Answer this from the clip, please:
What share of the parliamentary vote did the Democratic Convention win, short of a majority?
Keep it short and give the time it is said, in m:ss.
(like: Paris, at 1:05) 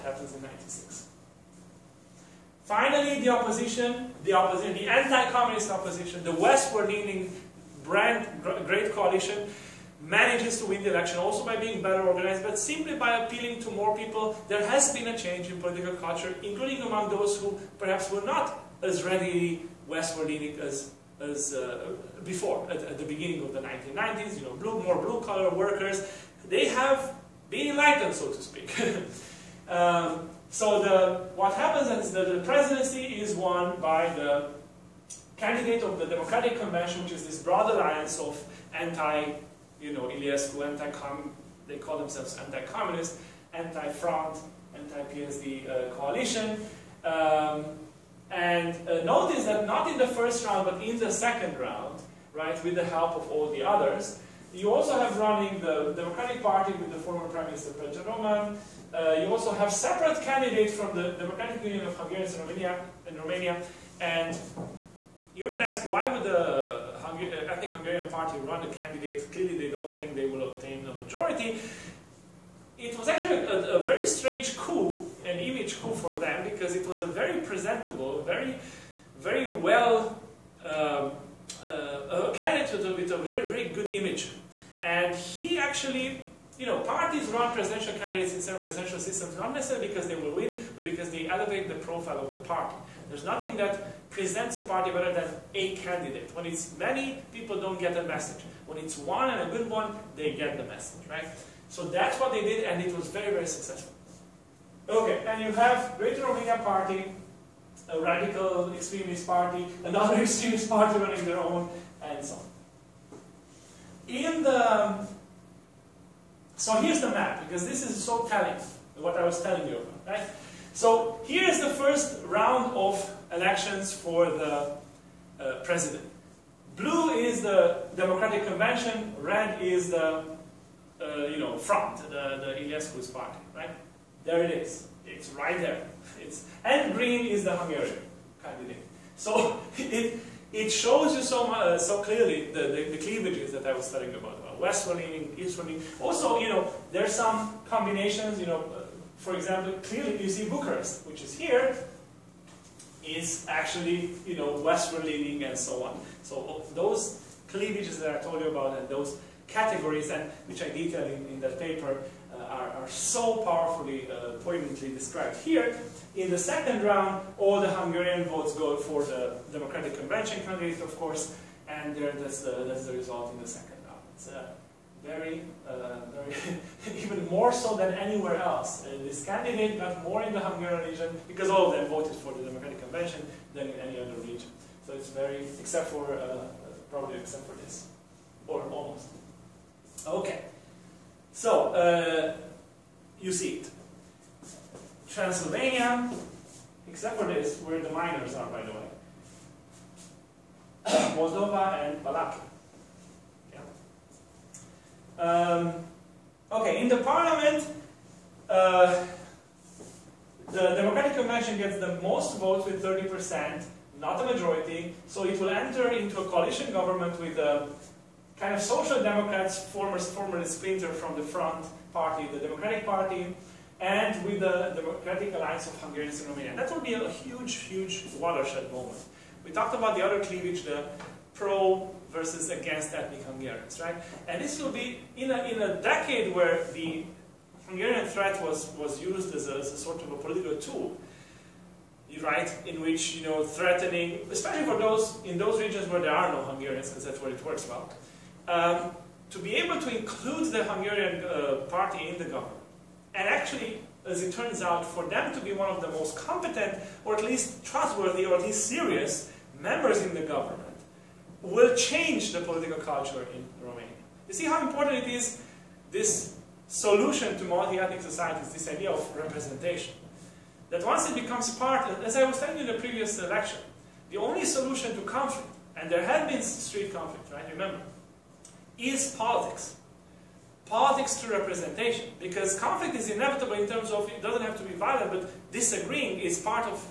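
30 percent, at 3:32.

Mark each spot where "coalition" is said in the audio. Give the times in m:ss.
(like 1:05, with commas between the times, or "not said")
0:08, 0:45, 3:36.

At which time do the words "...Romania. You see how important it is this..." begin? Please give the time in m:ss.
4:23.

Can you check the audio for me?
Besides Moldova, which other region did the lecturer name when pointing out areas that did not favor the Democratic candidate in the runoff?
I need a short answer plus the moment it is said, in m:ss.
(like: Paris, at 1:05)
Balak, at 3:22.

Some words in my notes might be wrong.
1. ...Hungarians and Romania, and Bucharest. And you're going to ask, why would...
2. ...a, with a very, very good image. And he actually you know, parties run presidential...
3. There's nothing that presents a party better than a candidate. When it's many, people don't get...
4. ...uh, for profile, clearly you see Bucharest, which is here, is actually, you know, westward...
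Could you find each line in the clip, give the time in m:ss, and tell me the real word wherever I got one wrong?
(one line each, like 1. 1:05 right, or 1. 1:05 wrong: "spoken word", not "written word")
1. 1:01 wrong: "Romania", not "Bucharest"
2. 1:22 right
3. 1:33 right
4. 2:28 wrong: "example", not "profile".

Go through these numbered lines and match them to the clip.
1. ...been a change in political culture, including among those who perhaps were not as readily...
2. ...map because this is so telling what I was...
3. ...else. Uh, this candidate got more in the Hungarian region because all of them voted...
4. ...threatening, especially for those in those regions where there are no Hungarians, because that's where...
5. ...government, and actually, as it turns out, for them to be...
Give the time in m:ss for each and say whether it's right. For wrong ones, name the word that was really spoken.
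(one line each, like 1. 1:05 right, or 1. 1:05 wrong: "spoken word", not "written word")
1. 0:14 right
2. 1:57 right
3. 2:58 right
4. 4:03 right
5. 4:12 right.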